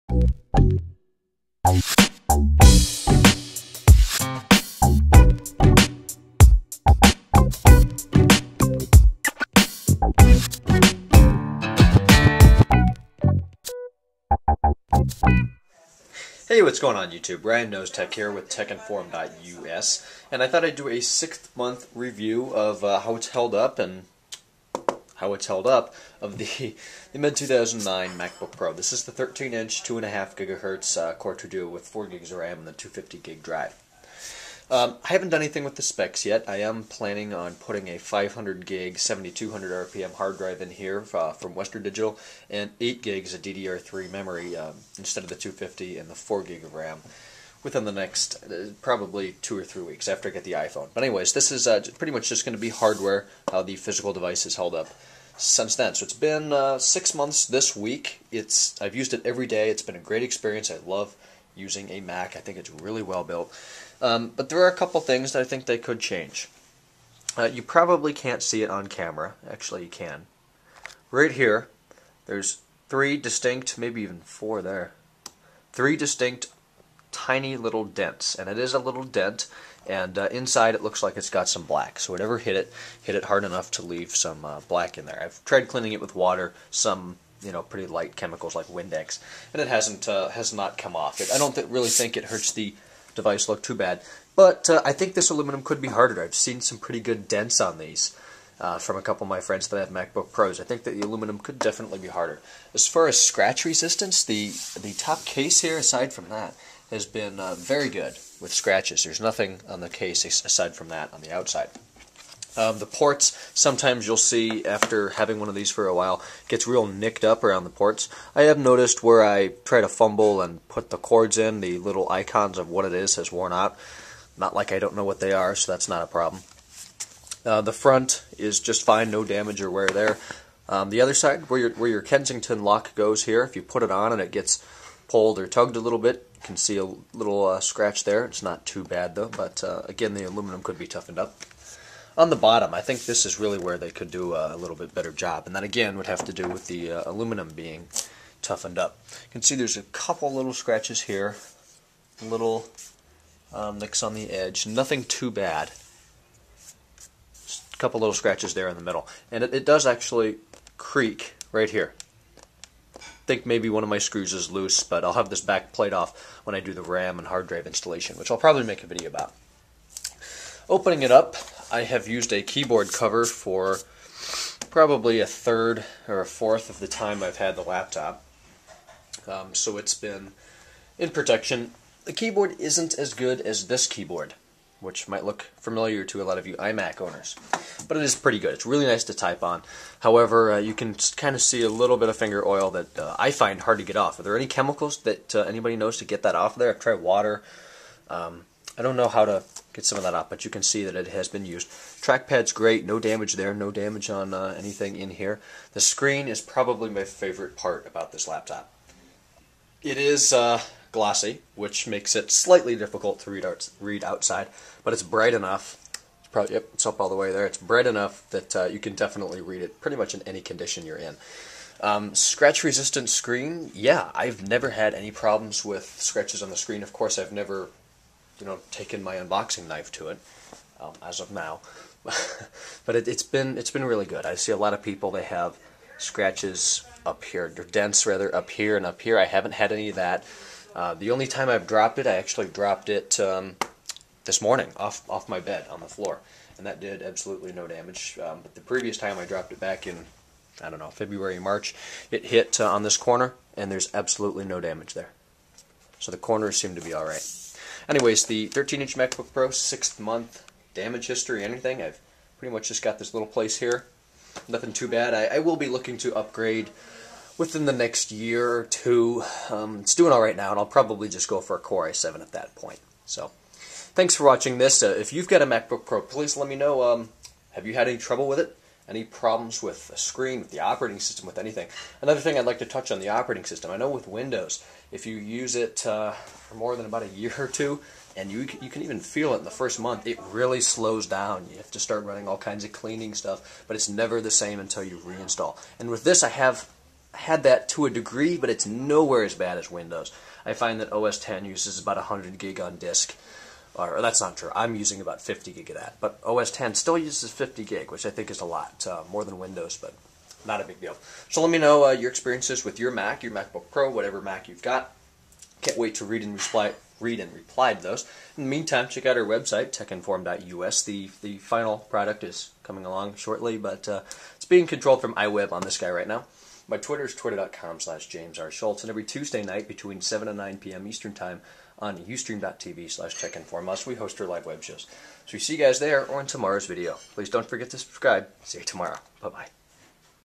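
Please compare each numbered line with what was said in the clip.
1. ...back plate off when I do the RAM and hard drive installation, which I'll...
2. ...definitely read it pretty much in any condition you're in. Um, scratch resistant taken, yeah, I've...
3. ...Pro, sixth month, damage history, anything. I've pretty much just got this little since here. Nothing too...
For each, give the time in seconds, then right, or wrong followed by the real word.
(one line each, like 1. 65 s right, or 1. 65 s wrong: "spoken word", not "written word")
1. 165 s right
2. 218 s wrong: "screen", not "taken"
3. 259 s wrong: "place", not "since".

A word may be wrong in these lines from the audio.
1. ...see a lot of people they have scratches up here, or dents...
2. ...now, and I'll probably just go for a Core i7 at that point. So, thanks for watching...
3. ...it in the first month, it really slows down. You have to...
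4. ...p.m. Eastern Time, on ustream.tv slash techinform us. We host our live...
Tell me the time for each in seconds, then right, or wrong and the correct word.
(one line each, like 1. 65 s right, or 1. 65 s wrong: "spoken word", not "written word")
1. 234 s right
2. 270 s right
3. 289 s right
4. 330 s right.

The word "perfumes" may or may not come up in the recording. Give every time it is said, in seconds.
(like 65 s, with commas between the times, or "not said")
not said.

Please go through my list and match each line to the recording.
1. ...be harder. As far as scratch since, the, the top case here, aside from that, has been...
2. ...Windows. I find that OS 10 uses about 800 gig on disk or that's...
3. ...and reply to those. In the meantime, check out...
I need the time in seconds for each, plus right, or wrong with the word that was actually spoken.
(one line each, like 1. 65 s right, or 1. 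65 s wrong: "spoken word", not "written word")
1. 101 s wrong: "resistance", not "since"
2. 299 s wrong: "100", not "800"
3. 317 s right.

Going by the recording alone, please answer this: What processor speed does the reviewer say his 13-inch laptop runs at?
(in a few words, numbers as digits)
2.5 GHz.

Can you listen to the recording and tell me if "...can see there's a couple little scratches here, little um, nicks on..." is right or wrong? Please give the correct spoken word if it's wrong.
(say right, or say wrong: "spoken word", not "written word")
right.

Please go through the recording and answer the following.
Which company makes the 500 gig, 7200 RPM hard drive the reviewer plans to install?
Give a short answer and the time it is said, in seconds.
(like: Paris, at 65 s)
Western Digital, at 41 s.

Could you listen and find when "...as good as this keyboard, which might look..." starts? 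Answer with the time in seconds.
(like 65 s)
182 s.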